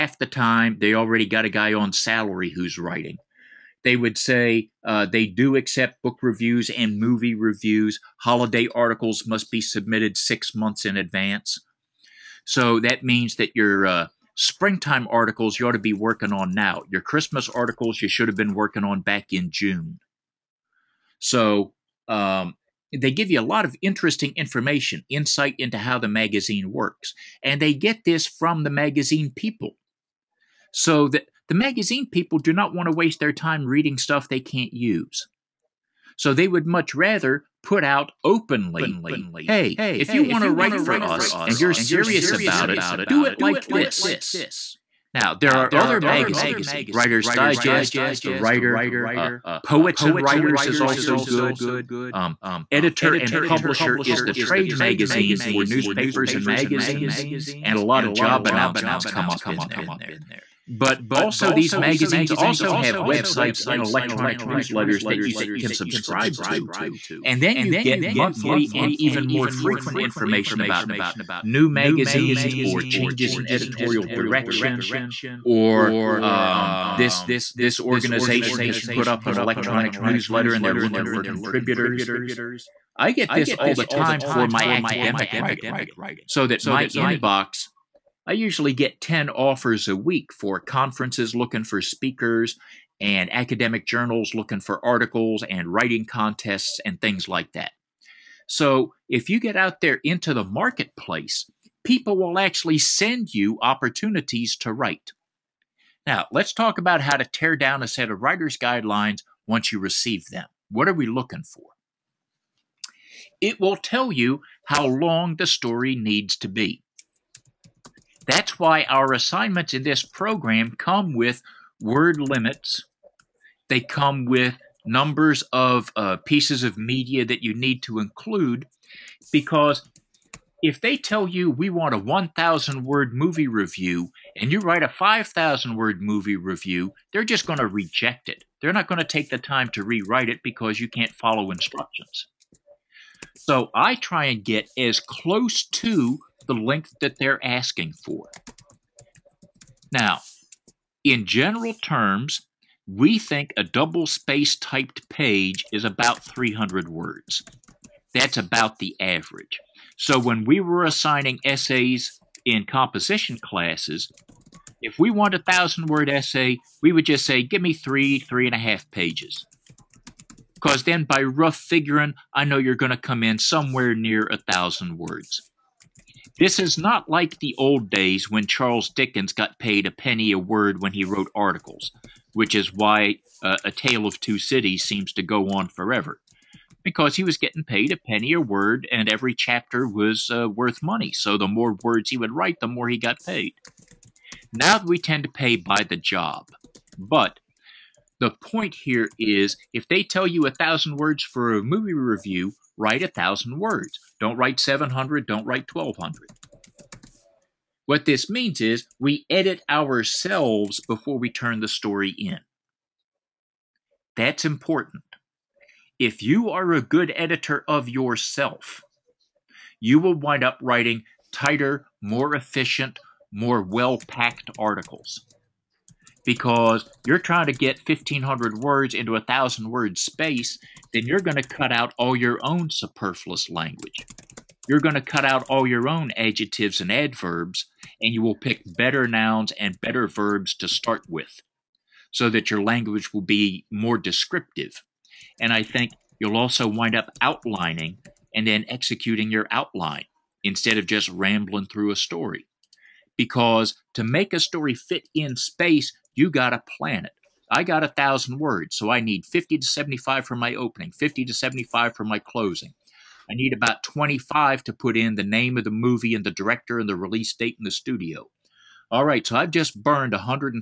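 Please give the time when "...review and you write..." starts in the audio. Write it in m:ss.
2:13.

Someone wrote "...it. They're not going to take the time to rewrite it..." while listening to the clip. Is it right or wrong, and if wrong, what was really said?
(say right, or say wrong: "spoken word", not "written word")
right.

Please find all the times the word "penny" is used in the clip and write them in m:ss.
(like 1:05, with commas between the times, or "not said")
2:59, 3:07.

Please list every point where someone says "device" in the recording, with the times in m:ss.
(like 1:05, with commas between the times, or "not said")
not said.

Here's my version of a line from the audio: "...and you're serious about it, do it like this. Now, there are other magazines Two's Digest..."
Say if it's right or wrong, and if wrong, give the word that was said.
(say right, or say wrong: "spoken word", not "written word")
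wrong: "Writer", not "Two".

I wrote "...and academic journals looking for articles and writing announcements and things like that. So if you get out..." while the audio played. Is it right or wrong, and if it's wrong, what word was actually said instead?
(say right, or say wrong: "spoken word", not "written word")
wrong: "contests", not "announcements".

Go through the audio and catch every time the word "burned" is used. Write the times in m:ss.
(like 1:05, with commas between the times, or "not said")
4:29.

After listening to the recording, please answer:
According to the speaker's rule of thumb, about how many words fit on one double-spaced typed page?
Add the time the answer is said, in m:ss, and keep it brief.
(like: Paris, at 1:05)
300, at 2:36.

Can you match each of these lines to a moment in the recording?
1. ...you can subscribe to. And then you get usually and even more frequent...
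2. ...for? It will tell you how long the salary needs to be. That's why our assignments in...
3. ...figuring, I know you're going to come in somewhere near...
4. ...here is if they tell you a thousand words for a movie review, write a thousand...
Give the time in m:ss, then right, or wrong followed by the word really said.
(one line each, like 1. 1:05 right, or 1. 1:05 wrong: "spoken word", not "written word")
1. 1:05 wrong: "monthly", not "usually"
2. 1:51 wrong: "story", not "salary"
3. 2:51 right
4. 3:18 right.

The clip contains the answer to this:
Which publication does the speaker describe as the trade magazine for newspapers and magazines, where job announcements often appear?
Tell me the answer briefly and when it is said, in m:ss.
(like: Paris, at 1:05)
Editor and Publisher, at 0:52.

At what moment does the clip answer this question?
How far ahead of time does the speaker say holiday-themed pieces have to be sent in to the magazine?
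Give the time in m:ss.
0:10.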